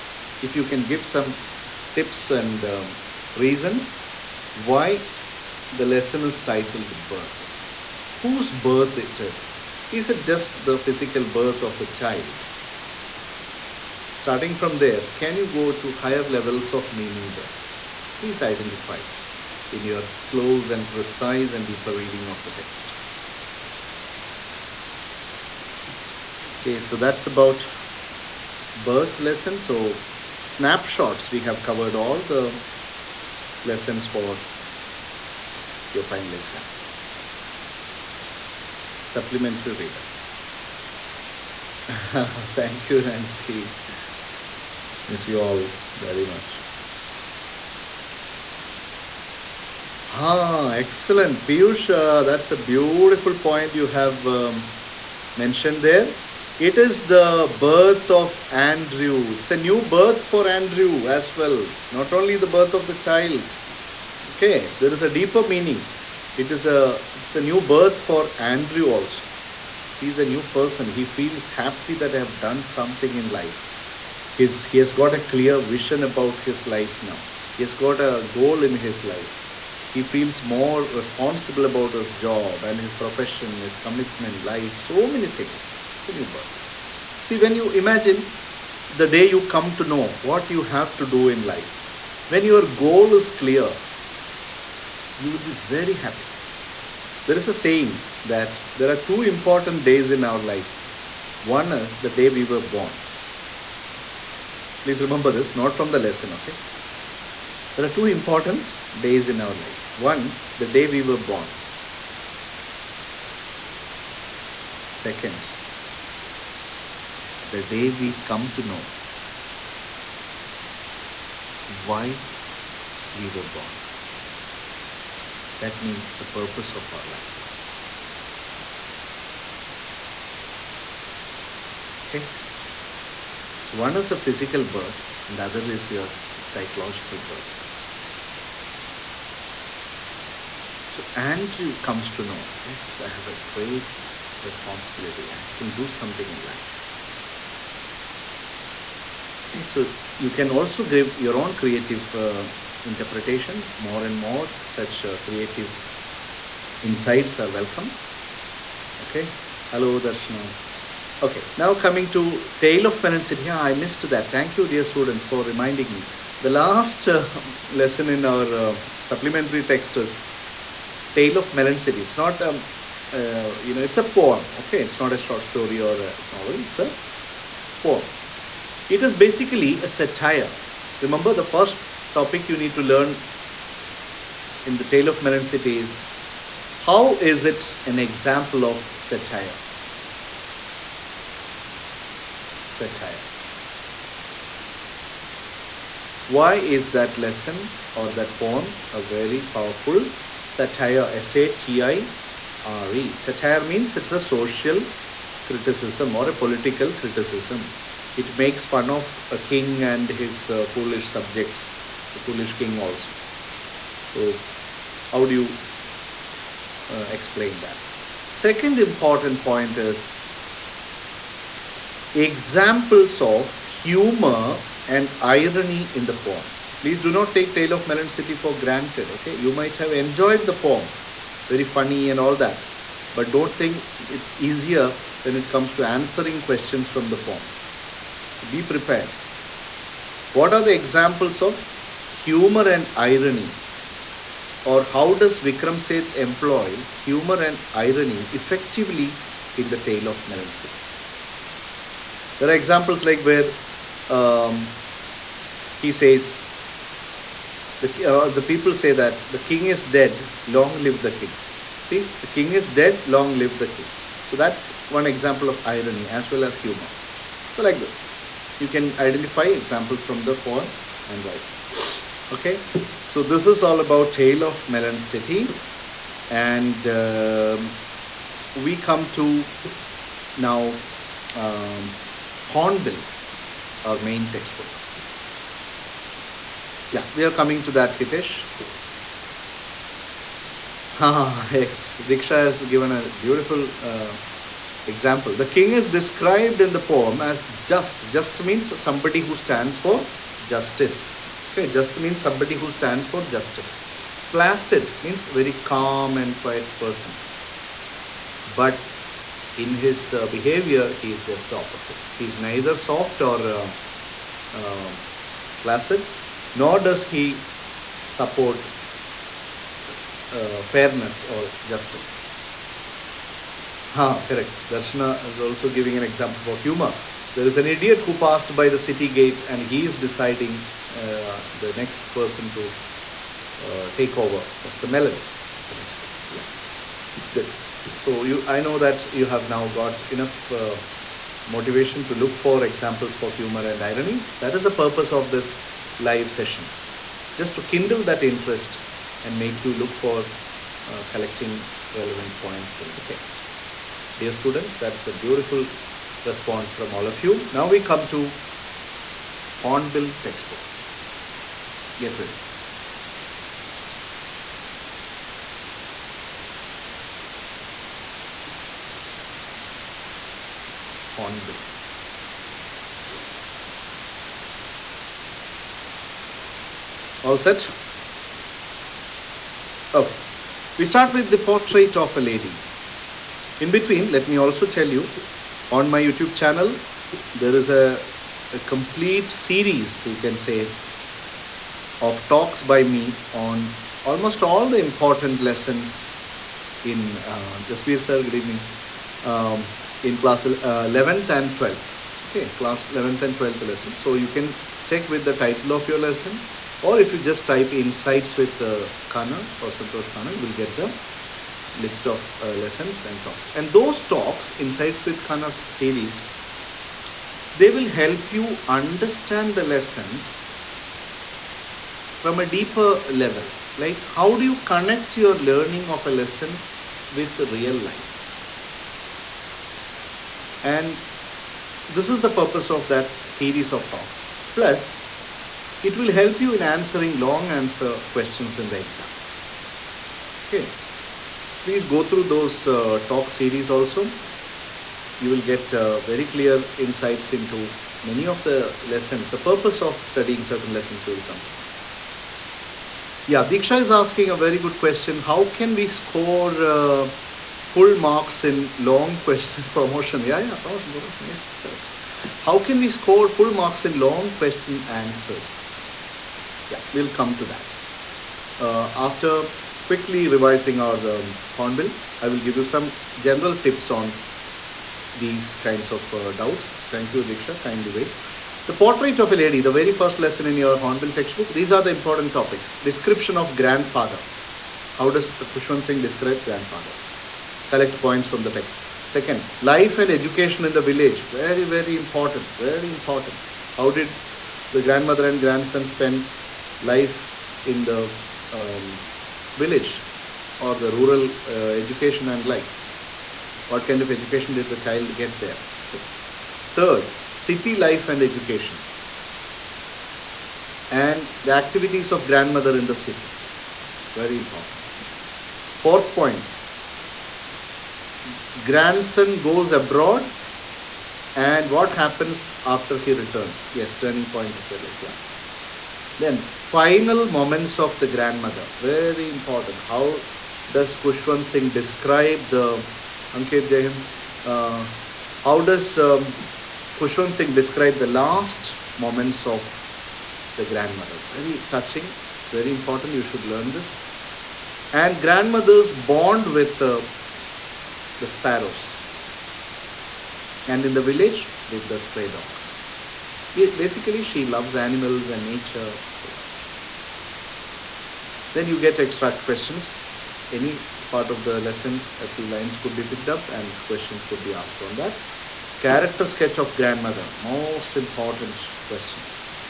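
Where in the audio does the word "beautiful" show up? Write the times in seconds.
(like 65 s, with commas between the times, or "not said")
52 s, 293 s, 355 s.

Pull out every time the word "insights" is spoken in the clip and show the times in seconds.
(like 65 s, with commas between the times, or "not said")
156 s, 407 s, 414 s, 446 s.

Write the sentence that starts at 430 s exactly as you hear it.
And this is the purpose of that series of talks.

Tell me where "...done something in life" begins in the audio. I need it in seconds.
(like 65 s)
72 s.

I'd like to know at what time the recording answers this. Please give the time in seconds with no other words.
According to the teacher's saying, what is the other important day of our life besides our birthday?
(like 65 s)
121 s.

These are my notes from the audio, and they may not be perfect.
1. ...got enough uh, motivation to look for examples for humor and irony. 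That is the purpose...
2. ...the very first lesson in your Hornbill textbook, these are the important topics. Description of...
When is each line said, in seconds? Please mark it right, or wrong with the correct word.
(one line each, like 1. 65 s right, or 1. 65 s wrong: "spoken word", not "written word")
1. 339 s right
2. 479 s right.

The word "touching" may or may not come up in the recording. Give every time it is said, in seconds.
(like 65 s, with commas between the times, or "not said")
541 s.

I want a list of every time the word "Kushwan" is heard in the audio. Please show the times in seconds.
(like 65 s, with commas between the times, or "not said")
485 s, 530 s.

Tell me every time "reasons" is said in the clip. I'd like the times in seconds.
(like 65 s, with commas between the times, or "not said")
3 s.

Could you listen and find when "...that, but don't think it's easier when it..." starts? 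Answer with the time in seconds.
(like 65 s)
232 s.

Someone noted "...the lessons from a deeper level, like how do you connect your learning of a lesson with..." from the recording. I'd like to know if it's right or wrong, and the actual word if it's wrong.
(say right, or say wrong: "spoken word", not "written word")
right.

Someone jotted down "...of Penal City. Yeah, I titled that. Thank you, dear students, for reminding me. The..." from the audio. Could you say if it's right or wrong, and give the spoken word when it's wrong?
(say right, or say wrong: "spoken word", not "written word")
wrong: "missed", not "titled".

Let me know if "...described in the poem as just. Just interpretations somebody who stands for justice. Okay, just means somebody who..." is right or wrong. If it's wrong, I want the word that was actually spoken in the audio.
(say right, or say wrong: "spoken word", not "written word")
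wrong: "means", not "interpretations".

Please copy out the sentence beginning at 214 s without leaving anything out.
So how do you uh, explain that?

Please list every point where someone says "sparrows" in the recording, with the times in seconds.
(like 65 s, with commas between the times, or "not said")
548 s.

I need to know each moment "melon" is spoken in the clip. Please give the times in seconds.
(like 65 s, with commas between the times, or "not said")
171 s, 185 s, 227 s, 250 s, 274 s, 334 s.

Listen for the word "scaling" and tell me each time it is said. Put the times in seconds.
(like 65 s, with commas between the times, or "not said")
not said.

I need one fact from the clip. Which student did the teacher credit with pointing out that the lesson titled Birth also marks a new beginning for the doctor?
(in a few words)
Piyush.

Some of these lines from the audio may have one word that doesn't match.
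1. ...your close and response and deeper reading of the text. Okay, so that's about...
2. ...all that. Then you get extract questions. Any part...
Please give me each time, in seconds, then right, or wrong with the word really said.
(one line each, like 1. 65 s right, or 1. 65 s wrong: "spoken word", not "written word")
1. 19 s wrong: "precise", not "response"
2. 556 s right.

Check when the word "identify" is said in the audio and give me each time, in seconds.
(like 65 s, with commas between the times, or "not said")
18 s, 268 s.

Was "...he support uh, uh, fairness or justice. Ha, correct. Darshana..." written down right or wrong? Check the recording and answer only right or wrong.
right.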